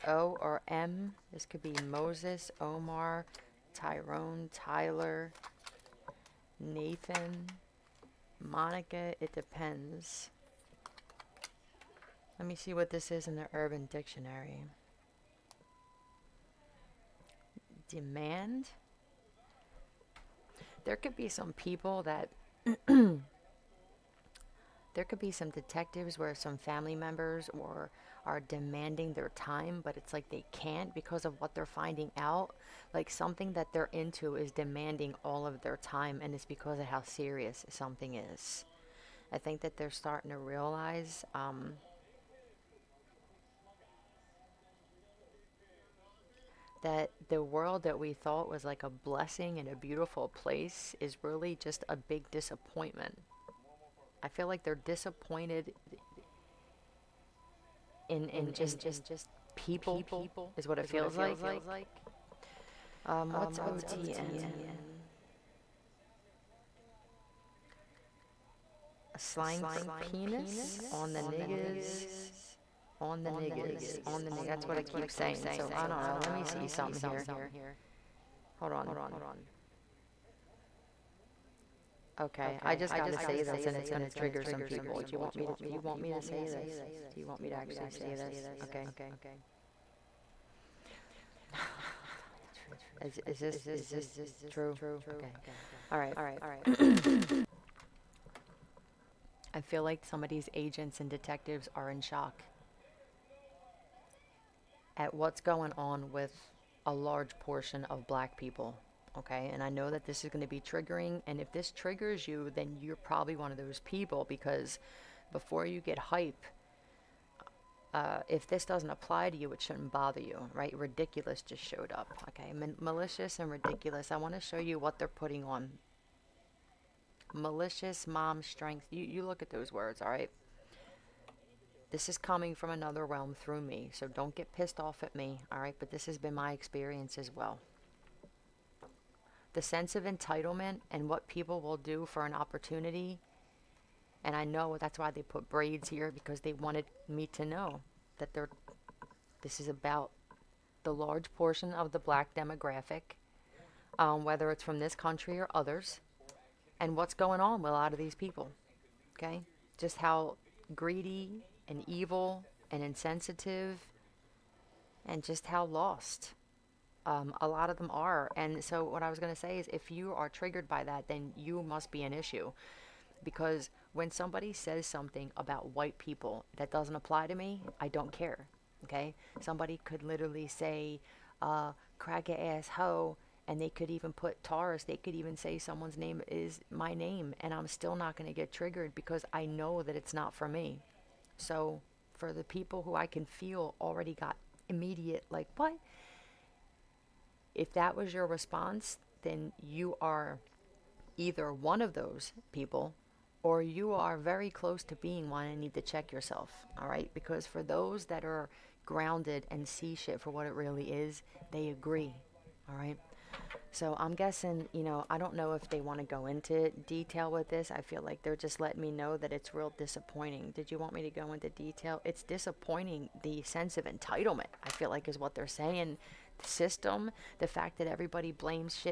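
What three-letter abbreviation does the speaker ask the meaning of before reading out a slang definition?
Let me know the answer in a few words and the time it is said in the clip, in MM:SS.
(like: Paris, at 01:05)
OTN, at 01:03.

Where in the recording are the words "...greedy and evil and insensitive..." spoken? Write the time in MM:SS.
02:40.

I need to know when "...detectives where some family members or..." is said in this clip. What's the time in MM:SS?
00:25.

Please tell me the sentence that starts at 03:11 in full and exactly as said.
So, for the people who I can feel already got immediate, like, what?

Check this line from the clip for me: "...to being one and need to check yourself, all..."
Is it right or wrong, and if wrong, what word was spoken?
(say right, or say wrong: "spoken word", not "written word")
right.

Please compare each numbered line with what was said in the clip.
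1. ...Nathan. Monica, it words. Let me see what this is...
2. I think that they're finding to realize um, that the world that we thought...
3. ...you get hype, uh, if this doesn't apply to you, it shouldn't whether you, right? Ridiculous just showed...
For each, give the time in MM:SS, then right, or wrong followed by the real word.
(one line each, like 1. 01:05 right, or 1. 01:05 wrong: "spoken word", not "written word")
1. 00:06 wrong: "depends", not "words"
2. 00:39 wrong: "starting", not "finding"
3. 01:55 wrong: "bother", not "whether".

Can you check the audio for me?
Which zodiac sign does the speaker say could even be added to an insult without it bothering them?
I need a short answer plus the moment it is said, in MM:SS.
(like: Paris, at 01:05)
Taurus, at 03:04.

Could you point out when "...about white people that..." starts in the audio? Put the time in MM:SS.
02:55.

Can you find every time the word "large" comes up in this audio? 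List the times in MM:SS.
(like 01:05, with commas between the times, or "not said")
01:46, 02:30.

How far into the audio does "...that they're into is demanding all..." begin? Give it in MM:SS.
00:33.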